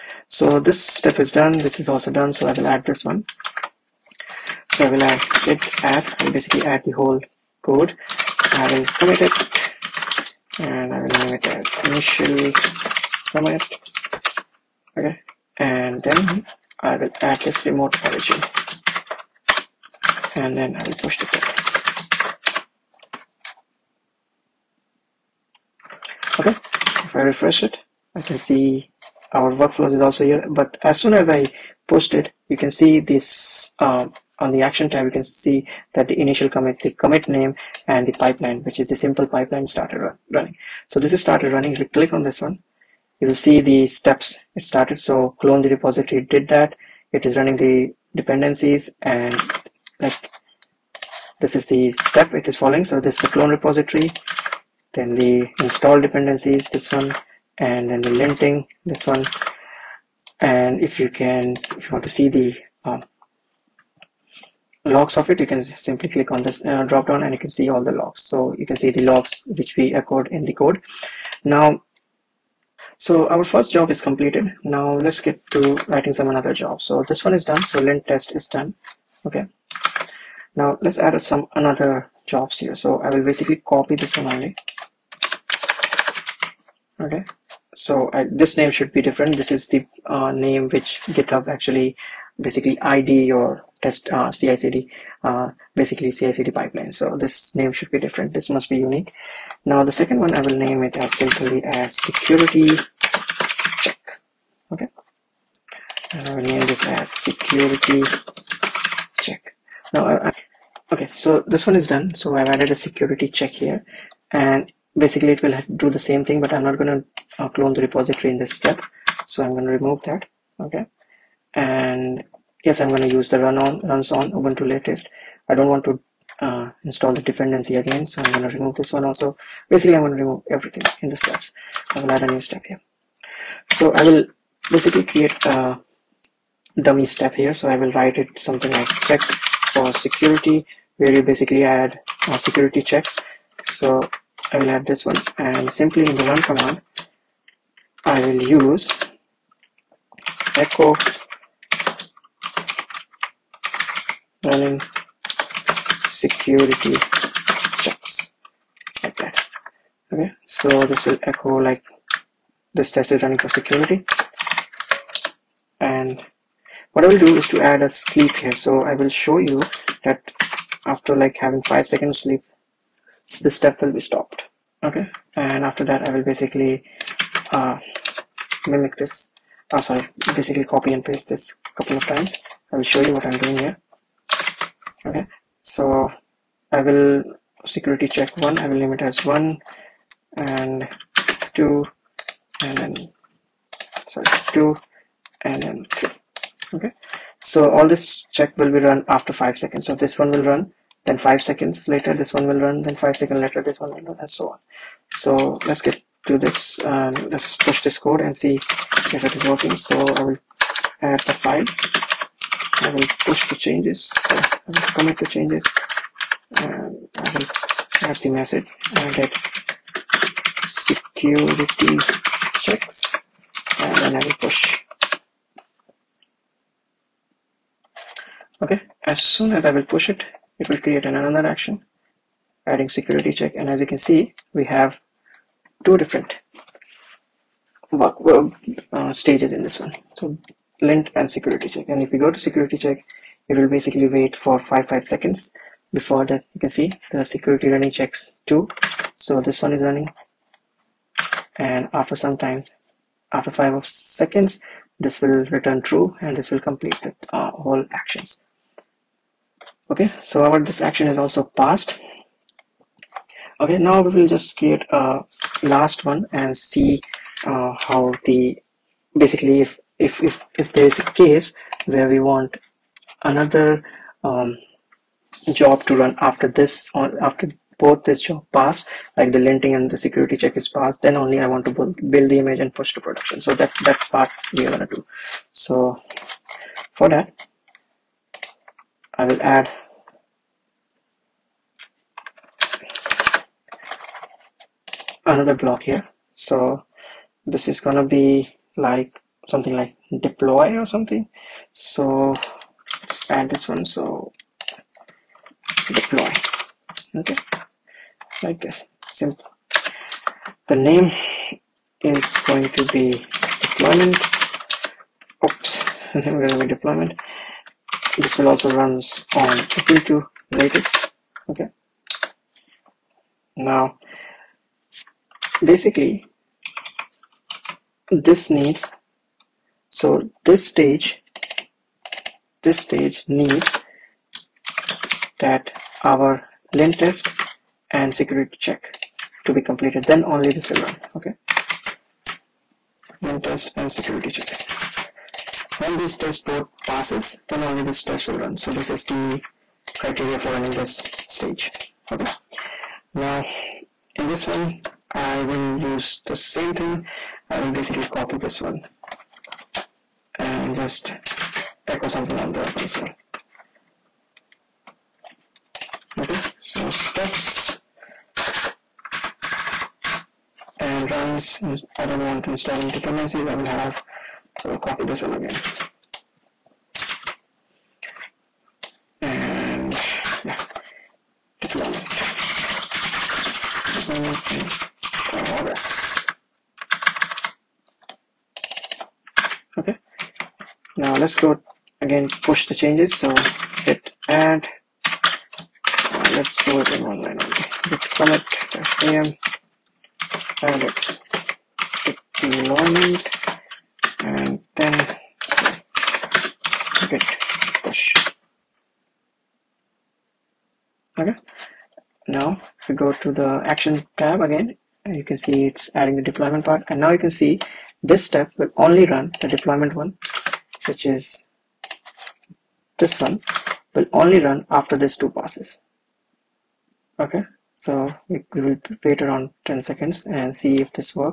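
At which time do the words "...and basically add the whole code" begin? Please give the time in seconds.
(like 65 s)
6 s.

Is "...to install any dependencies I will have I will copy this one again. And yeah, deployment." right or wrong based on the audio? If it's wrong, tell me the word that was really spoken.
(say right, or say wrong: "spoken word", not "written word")
right.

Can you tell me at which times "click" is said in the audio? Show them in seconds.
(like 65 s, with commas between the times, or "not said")
41 s, 66 s.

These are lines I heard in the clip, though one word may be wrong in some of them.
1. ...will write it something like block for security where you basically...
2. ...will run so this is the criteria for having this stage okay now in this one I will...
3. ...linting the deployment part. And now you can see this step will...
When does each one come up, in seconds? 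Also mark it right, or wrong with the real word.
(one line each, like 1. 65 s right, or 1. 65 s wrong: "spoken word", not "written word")
1. 137 s wrong: "check", not "block"
2. 348 s wrong: "running", not "having"
3. 415 s wrong: "adding", not "linting".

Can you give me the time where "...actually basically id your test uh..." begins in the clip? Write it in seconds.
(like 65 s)
91 s.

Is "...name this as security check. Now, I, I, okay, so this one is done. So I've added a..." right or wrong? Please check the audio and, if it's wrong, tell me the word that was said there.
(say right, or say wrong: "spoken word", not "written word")
right.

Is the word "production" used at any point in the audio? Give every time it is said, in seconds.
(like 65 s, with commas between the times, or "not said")
283 s.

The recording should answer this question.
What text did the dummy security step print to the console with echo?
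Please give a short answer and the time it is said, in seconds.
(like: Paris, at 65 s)
running security checks, at 154 s.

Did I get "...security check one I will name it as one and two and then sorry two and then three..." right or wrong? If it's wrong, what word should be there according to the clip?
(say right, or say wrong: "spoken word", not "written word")
right.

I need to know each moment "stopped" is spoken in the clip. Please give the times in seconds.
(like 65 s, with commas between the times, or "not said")
174 s.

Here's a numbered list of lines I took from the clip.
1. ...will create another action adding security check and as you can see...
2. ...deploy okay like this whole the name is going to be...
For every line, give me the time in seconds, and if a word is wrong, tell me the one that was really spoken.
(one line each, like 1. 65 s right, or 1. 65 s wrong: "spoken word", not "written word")
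1. 230 s right
2. 305 s wrong: "simple", not "whole".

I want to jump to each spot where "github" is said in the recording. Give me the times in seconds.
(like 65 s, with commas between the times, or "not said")
91 s.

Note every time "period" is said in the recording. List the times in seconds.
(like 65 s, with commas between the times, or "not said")
not said.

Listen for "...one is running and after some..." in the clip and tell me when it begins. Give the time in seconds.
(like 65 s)
249 s.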